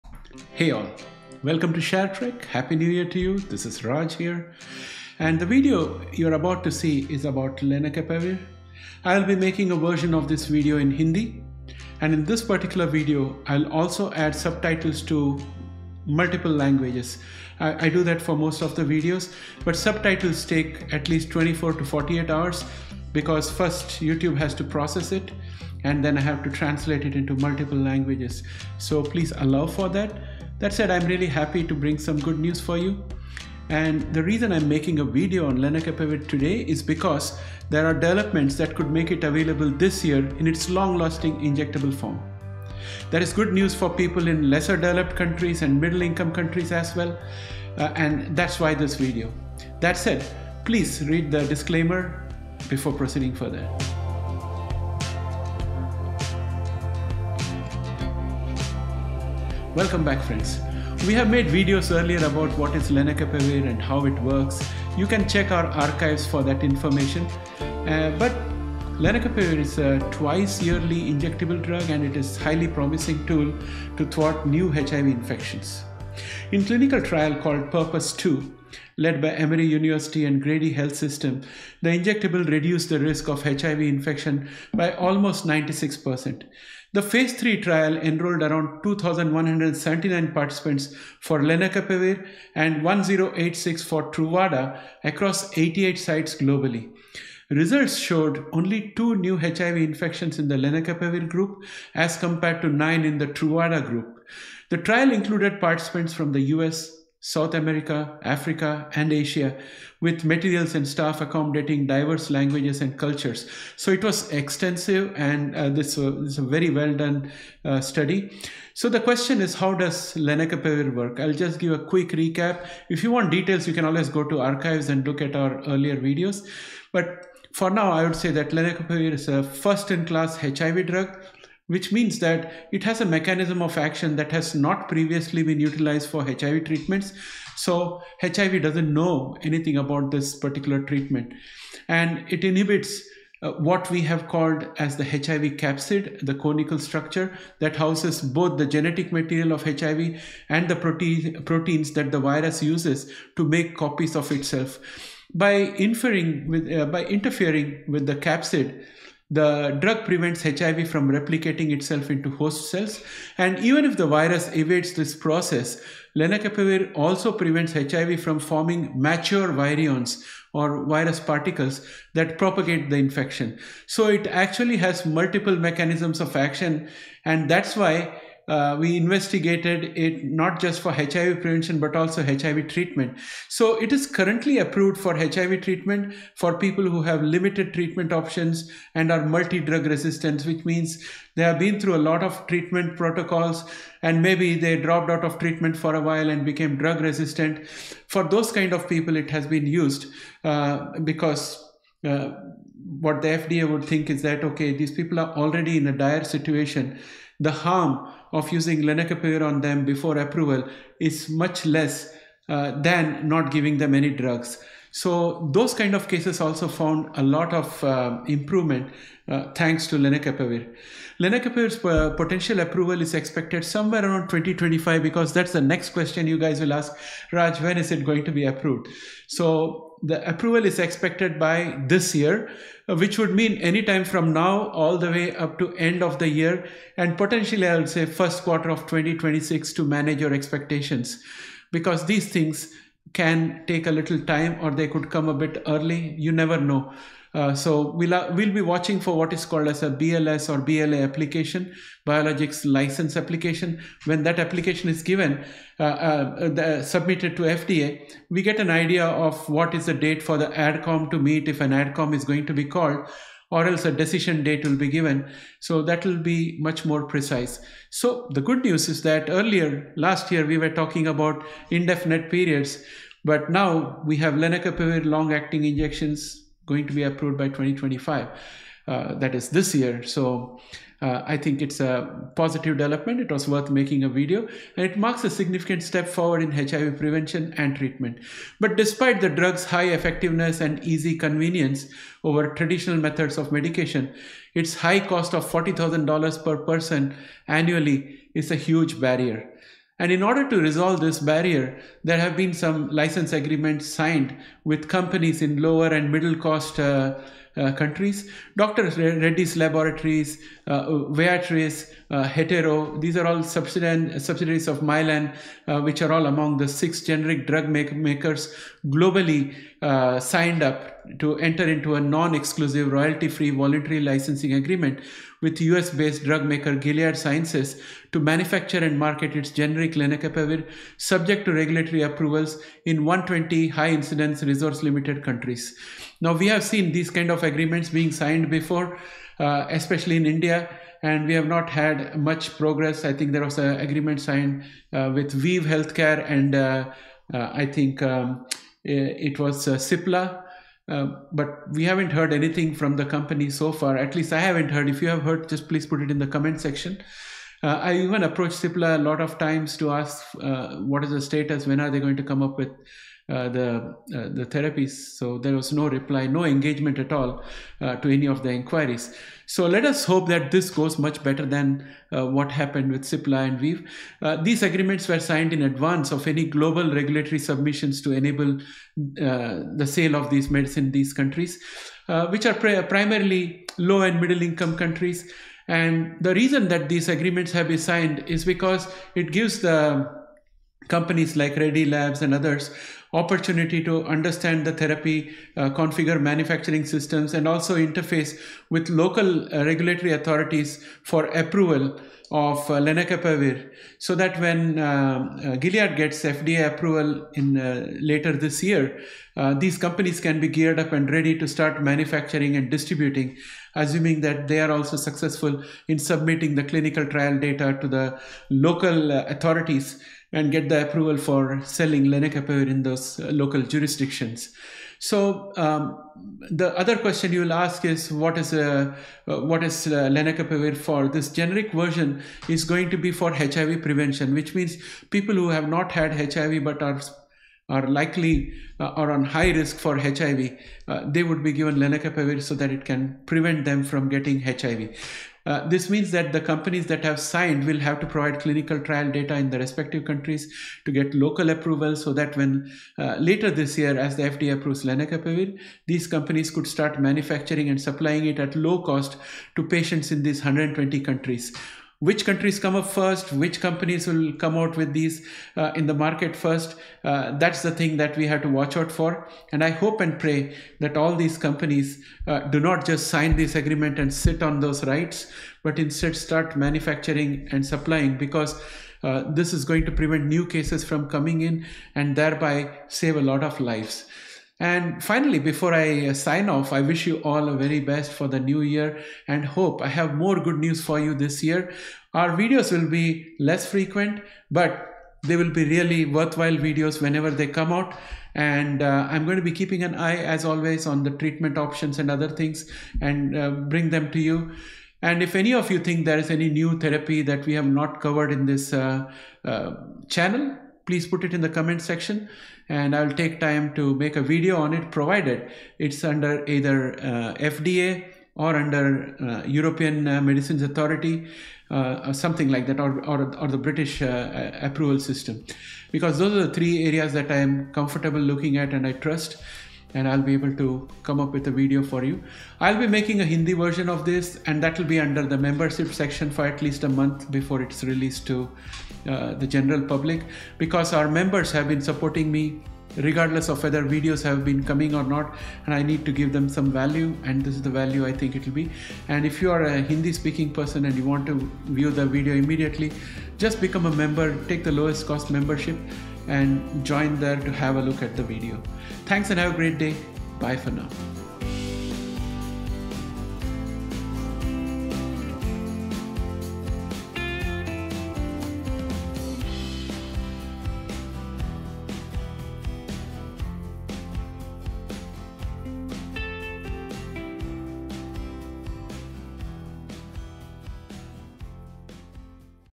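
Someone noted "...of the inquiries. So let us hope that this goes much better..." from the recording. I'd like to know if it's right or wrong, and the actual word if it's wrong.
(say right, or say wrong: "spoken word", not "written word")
right.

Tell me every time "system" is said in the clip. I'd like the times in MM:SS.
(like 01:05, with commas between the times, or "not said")
01:20, 06:36, 08:44.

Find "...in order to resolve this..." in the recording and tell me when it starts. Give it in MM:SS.
05:00.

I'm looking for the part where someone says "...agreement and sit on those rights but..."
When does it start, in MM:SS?
07:53.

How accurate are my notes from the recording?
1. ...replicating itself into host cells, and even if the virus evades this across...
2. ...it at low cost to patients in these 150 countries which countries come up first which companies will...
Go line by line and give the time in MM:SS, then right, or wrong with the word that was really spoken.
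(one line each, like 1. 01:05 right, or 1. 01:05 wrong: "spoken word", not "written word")
1. 02:41 wrong: "process", not "across"
2. 07:38 wrong: "120", not "150".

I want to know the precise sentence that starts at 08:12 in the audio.
Our videos will be less frequent, but they will be really worthwhile videos whenever they come out.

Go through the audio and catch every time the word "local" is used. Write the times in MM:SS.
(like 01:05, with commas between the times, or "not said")
06:38, 06:58, 07:03, 07:31.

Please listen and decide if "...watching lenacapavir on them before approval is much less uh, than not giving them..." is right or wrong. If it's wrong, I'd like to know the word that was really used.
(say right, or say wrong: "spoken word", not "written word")
wrong: "using", not "watching".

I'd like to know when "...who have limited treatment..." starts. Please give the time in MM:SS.
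03:06.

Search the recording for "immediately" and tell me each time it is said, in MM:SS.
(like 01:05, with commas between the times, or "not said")
09:12.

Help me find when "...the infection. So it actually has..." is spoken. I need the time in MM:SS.
02:52.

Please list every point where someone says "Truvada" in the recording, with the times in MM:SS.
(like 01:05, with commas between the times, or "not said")
01:34, 01:43.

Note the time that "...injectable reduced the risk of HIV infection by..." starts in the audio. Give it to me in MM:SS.
01:21.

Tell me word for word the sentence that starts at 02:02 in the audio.
If you want details, you can always go to archives and look at our earlier videos.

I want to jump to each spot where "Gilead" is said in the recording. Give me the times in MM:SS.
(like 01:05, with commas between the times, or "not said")
05:26, 06:45.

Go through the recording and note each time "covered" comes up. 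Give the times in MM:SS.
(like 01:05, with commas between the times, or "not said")
08:27.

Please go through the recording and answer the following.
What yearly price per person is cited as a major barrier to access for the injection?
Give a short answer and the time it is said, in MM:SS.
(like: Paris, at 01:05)
$40,000, at 04:55.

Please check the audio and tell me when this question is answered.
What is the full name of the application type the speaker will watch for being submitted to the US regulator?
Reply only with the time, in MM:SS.
04:12.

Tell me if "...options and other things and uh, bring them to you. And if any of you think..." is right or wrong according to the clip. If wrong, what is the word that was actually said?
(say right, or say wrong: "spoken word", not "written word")
right.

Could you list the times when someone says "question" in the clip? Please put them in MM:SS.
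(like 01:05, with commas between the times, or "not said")
01:58, 03:45, 07:06.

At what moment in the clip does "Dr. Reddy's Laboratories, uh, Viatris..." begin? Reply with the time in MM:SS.
05:08.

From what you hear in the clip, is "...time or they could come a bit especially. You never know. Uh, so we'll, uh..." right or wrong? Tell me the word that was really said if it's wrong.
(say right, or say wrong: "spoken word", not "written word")
wrong: "early", not "especially".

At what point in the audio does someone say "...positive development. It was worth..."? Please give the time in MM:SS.
04:42.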